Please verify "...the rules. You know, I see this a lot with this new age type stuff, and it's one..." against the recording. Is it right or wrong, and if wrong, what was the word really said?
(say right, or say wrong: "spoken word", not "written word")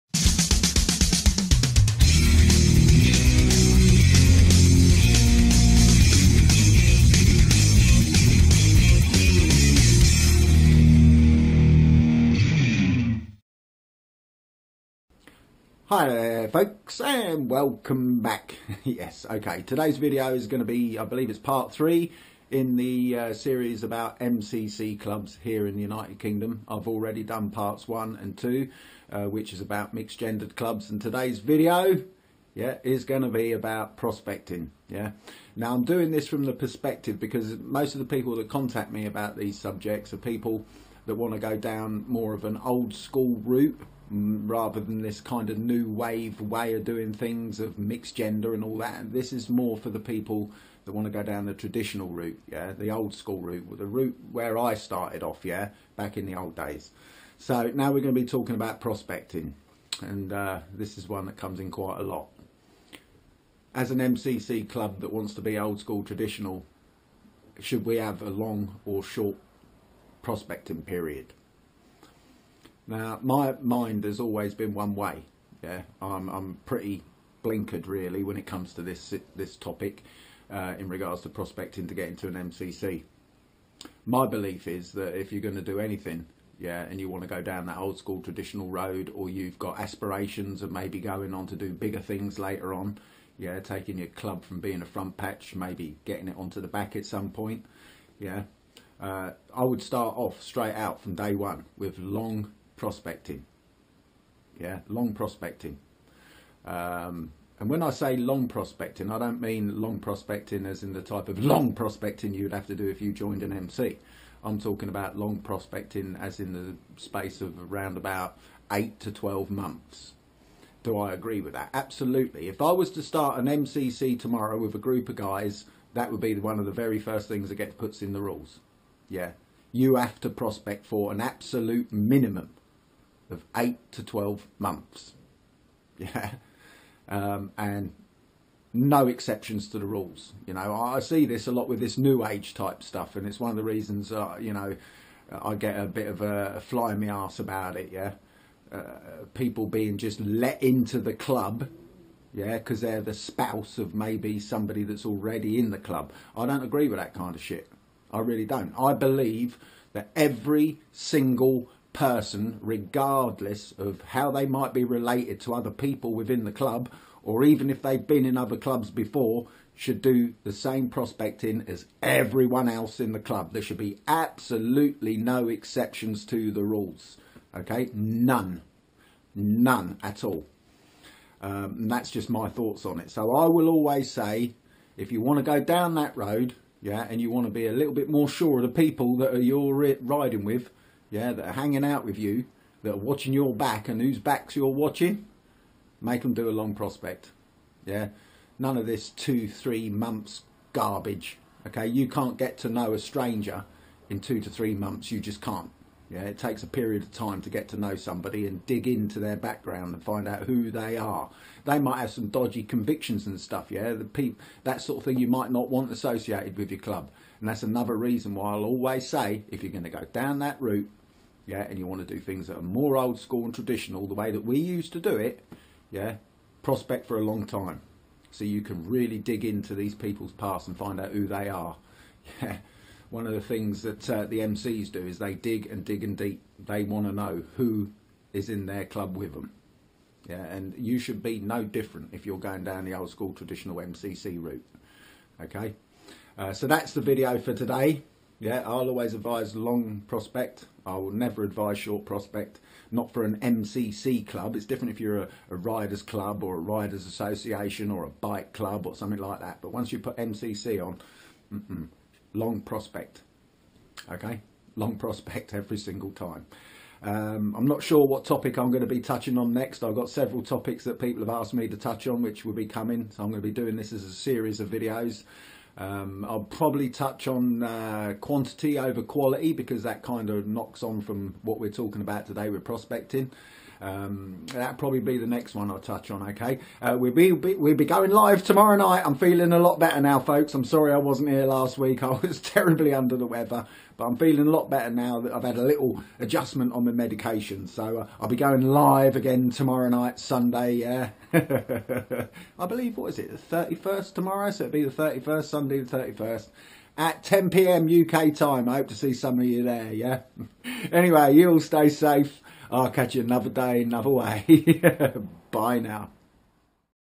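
right.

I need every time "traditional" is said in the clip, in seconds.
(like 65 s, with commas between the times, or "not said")
51 s, 66 s, 88 s, 223 s, 243 s.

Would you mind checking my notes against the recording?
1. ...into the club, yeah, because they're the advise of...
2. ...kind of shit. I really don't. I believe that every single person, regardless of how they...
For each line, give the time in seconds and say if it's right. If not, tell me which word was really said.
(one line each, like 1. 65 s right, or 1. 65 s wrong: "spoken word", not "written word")
1. 150 s wrong: "spouse", not "advise"
2. 157 s right.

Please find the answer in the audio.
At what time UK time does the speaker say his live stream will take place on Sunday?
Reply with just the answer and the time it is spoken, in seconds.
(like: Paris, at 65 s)
10 p.m., at 307 s.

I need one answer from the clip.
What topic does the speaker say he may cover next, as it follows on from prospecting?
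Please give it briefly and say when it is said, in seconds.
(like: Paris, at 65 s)
Quantity over quality, at 278 s.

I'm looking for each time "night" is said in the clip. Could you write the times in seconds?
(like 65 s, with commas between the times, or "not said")
288 s, 299 s.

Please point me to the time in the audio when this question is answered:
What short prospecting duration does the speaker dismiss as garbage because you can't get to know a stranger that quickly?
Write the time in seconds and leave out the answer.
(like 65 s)
199 s.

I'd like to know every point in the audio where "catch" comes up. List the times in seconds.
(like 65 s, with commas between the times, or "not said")
312 s.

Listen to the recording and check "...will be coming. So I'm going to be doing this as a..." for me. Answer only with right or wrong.
right.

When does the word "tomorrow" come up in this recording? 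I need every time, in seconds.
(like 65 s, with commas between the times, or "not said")
124 s, 288 s, 299 s, 304 s.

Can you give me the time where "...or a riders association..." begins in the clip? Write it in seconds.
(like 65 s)
256 s.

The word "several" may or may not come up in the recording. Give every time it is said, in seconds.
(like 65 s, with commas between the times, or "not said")
270 s.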